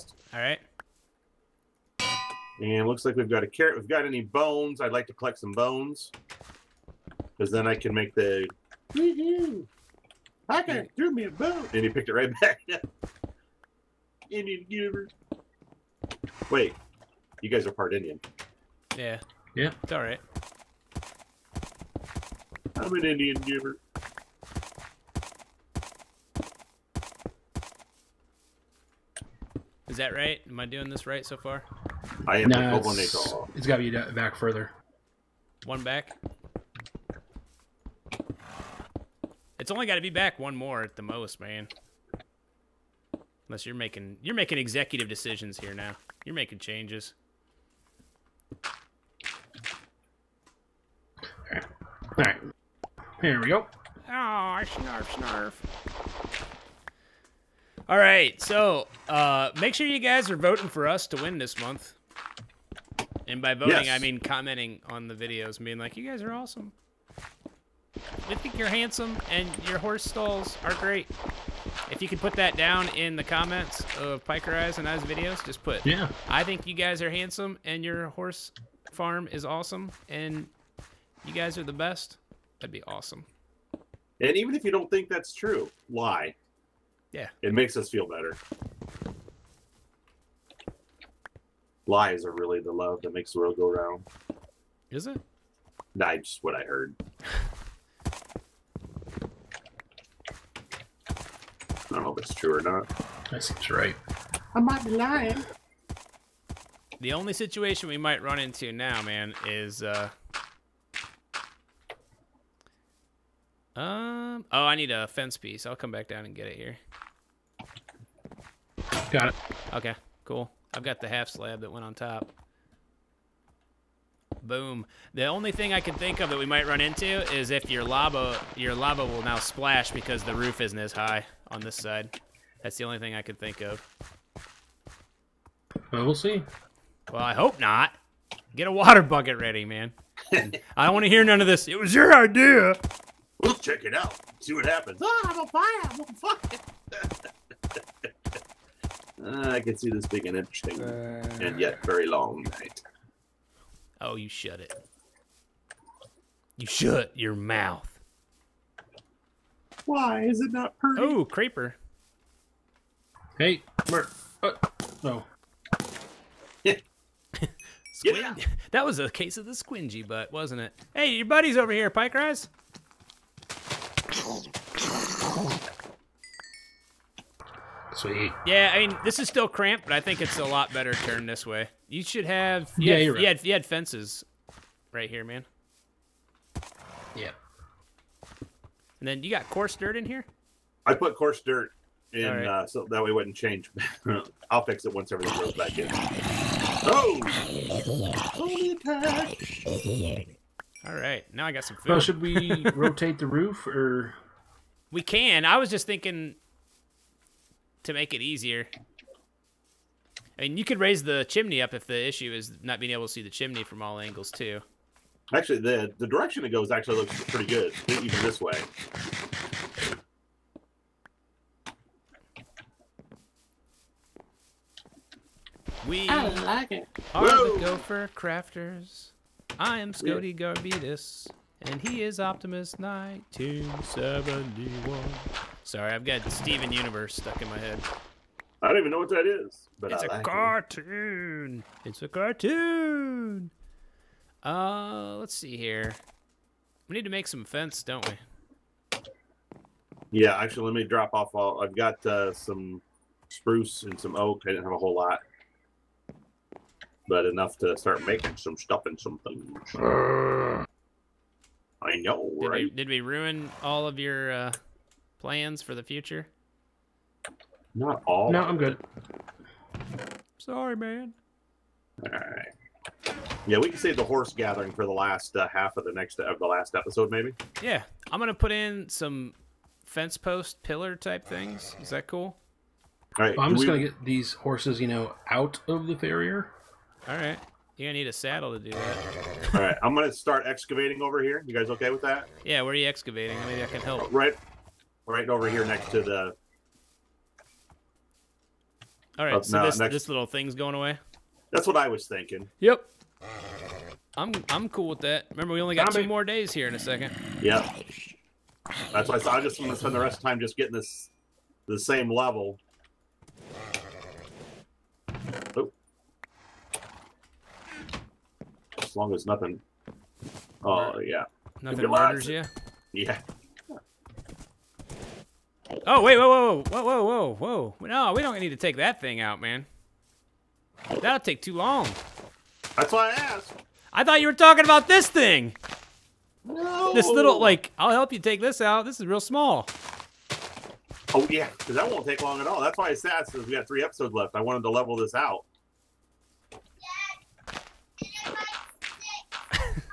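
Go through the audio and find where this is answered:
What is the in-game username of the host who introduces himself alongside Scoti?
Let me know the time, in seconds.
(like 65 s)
232 s.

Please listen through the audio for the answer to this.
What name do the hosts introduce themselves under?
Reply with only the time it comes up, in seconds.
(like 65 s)
227 s.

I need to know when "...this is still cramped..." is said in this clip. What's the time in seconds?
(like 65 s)
179 s.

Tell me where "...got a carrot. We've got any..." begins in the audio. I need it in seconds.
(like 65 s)
3 s.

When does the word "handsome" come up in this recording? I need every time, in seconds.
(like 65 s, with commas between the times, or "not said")
68 s, 77 s.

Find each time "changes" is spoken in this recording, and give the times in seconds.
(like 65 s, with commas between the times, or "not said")
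46 s, 193 s.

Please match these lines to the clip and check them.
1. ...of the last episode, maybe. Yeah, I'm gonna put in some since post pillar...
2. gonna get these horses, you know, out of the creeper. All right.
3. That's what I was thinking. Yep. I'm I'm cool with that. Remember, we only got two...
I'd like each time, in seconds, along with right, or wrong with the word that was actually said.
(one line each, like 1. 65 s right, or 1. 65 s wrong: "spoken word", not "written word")
1. 276 s wrong: "fence", not "since"
2. 283 s wrong: "farrier", not "creeper"
3. 301 s right.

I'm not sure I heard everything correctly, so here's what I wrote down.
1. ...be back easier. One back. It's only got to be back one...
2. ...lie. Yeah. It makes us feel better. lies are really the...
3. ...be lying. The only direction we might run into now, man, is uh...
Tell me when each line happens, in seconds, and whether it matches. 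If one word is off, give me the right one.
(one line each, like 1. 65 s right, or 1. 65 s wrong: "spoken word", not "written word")
1. 33 s wrong: "further", not "easier"
2. 85 s right
3. 104 s wrong: "situation", not "direction".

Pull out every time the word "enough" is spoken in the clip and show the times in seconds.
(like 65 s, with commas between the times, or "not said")
257 s.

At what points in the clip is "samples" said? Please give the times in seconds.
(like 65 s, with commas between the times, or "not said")
not said.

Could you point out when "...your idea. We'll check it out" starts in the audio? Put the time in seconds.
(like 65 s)
141 s.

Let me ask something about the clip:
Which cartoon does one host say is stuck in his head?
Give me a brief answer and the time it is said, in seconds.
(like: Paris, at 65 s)
Steven Universe, at 236 s.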